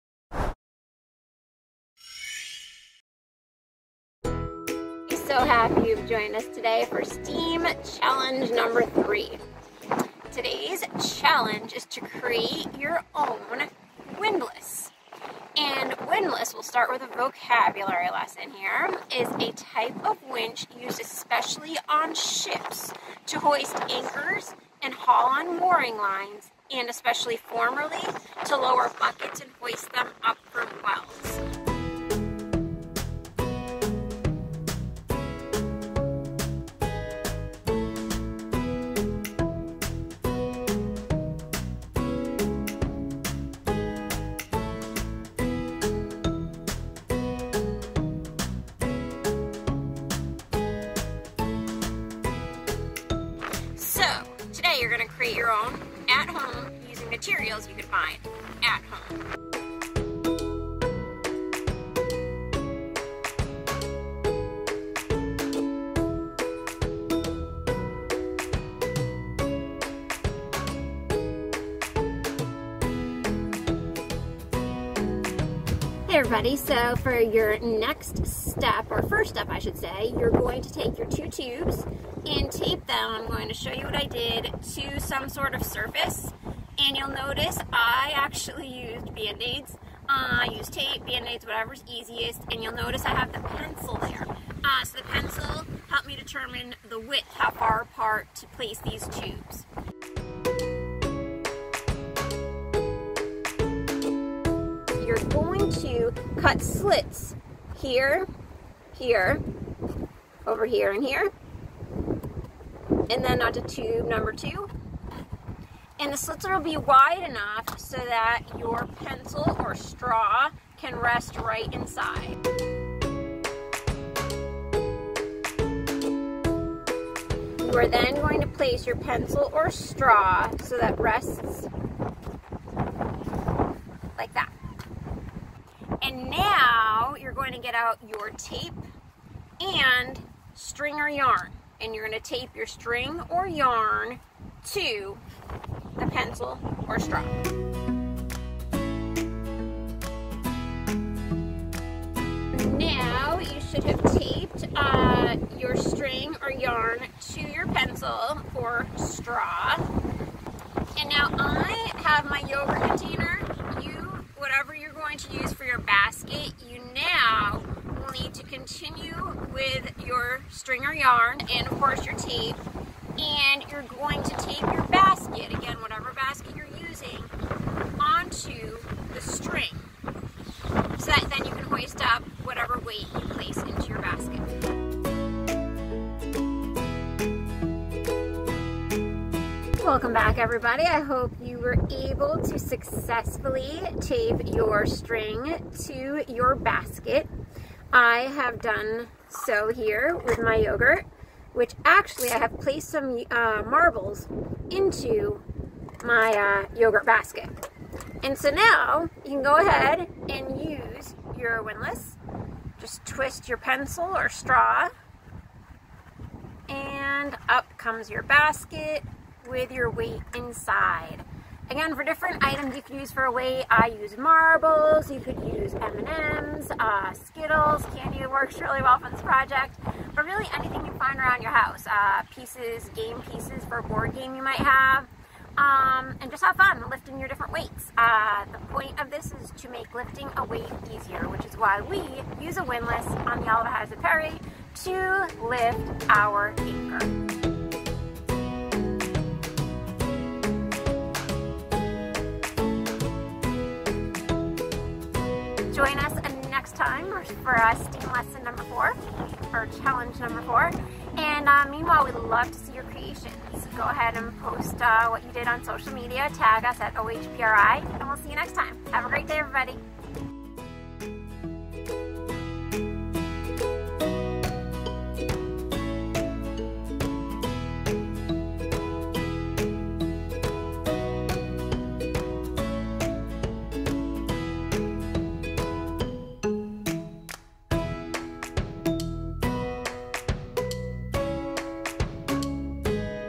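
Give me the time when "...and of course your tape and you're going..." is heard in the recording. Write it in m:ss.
2:51.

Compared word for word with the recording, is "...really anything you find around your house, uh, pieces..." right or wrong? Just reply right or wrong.
right.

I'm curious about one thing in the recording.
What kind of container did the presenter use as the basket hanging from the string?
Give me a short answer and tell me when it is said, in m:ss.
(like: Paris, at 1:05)
Yogurt container, at 2:42.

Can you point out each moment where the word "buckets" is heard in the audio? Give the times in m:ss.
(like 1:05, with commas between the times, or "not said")
0:28.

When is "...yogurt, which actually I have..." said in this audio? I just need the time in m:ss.
3:20.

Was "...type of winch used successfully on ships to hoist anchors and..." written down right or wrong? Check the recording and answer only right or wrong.
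wrong.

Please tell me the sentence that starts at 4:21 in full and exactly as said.
And uh, meanwhile, we'd love to see your creations.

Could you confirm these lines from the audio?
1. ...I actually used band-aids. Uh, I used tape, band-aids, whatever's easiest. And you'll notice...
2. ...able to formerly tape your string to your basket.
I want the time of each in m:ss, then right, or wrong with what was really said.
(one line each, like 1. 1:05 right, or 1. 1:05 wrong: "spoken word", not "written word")
1. 1:27 right
2. 3:11 wrong: "successfully", not "formerly".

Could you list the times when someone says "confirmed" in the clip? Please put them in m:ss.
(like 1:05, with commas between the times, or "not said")
not said.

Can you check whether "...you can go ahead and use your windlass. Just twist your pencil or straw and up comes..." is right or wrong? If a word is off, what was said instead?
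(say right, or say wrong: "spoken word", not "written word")
right.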